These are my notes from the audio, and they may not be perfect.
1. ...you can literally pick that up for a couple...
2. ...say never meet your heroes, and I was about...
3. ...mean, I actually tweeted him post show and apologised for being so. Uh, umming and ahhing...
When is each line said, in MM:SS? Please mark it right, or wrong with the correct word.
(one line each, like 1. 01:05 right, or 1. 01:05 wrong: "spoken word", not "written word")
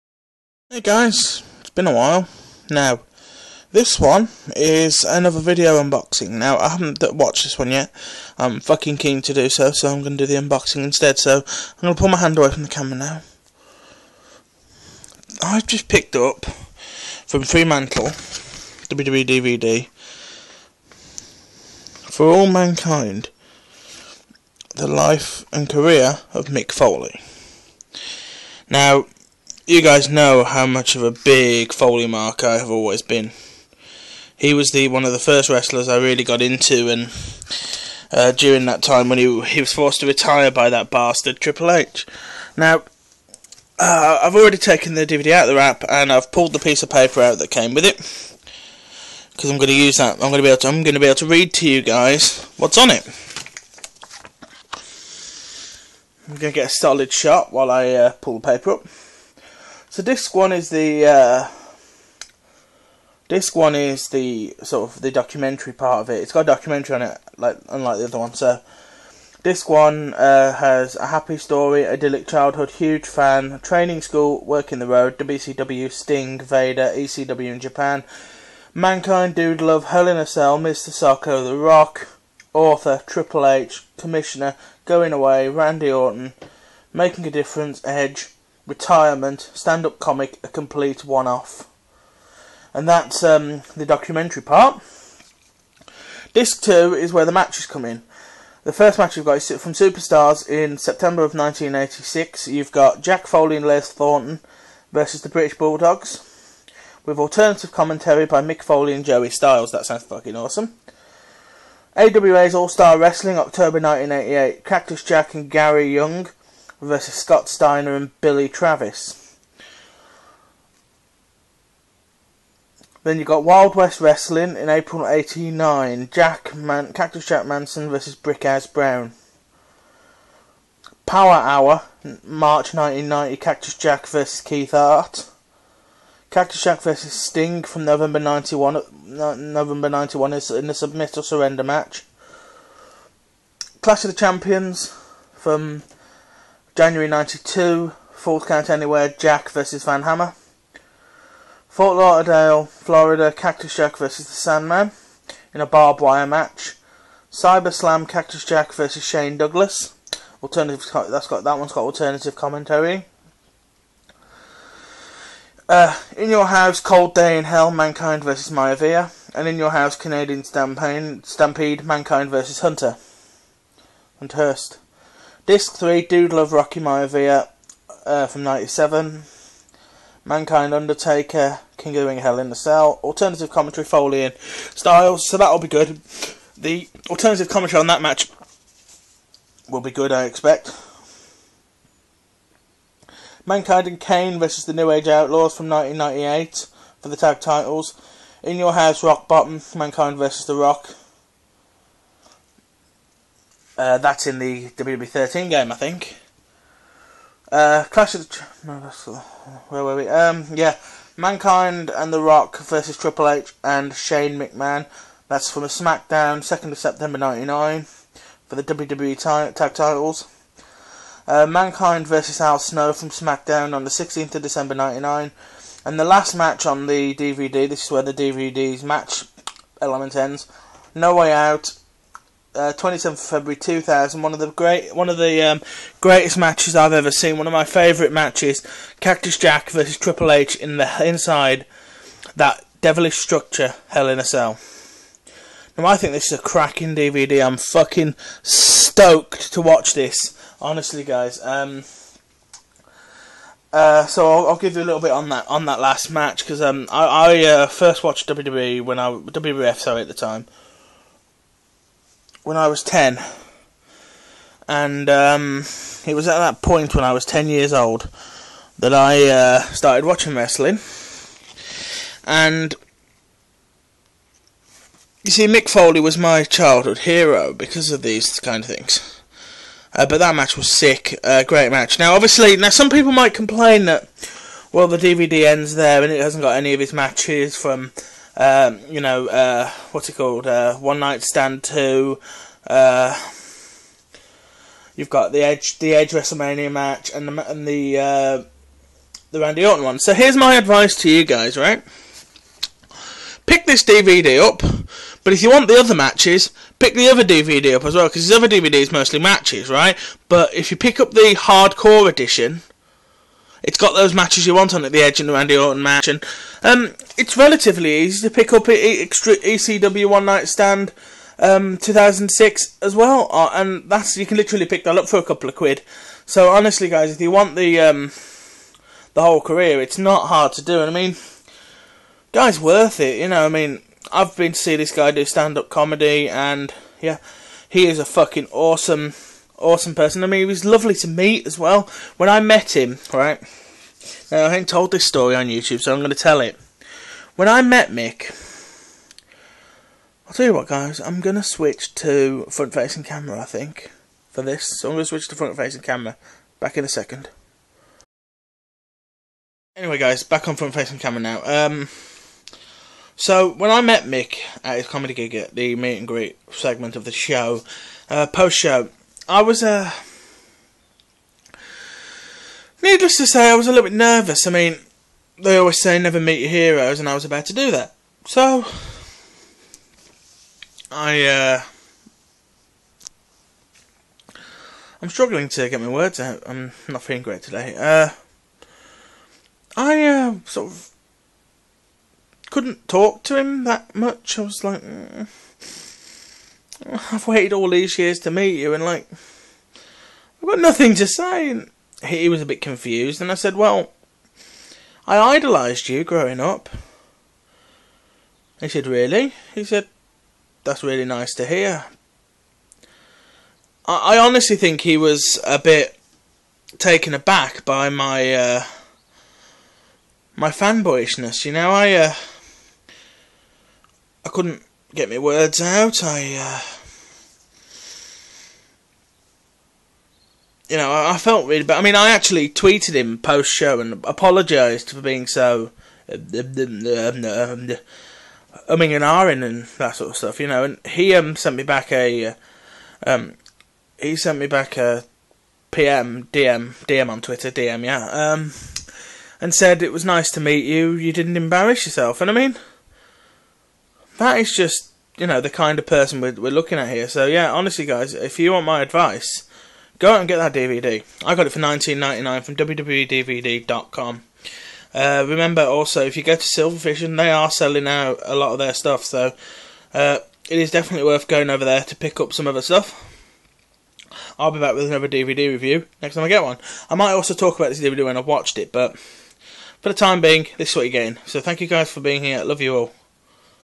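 1. 05:24 right
2. 06:15 right
3. 07:11 right.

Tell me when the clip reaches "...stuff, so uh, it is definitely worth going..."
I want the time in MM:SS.
07:48.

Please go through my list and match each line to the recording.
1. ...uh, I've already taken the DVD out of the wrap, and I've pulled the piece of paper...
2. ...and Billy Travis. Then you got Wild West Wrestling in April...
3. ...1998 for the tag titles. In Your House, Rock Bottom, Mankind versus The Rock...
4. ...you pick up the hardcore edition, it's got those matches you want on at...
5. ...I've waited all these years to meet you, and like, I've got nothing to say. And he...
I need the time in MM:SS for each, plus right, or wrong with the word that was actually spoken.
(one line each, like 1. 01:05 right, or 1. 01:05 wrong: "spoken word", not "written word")
1. 00:43 right
2. 01:57 right
3. 03:15 right
4. 05:10 right
5. 06:37 right.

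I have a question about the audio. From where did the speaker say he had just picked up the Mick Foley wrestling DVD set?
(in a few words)
Fremantle.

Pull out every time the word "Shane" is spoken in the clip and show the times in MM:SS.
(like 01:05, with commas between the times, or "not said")
02:39, 03:33.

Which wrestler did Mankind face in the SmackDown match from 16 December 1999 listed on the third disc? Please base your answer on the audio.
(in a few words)
Al Snow.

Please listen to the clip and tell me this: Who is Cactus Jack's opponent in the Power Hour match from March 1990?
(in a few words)
Keith Hart.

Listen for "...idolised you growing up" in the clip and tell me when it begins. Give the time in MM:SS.
06:45.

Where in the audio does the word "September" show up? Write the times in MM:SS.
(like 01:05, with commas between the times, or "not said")
01:40, 03:36.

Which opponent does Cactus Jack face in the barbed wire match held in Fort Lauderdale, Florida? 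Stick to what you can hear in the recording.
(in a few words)
The Sandman.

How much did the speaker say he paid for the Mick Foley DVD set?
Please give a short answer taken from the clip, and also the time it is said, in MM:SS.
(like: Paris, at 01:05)
19.99, at 07:41.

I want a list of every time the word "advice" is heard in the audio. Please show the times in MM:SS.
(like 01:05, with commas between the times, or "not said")
05:00, 07:38.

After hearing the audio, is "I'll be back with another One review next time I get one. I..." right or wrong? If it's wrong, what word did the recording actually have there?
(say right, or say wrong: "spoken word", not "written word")
wrong: "DVD", not "One".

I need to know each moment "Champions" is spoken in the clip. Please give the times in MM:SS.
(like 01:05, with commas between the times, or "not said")
02:24.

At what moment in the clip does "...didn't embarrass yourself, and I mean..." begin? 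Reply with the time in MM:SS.
07:31.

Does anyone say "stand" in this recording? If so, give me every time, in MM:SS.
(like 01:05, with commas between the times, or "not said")
01:29, 04:51, 05:20, 05:35.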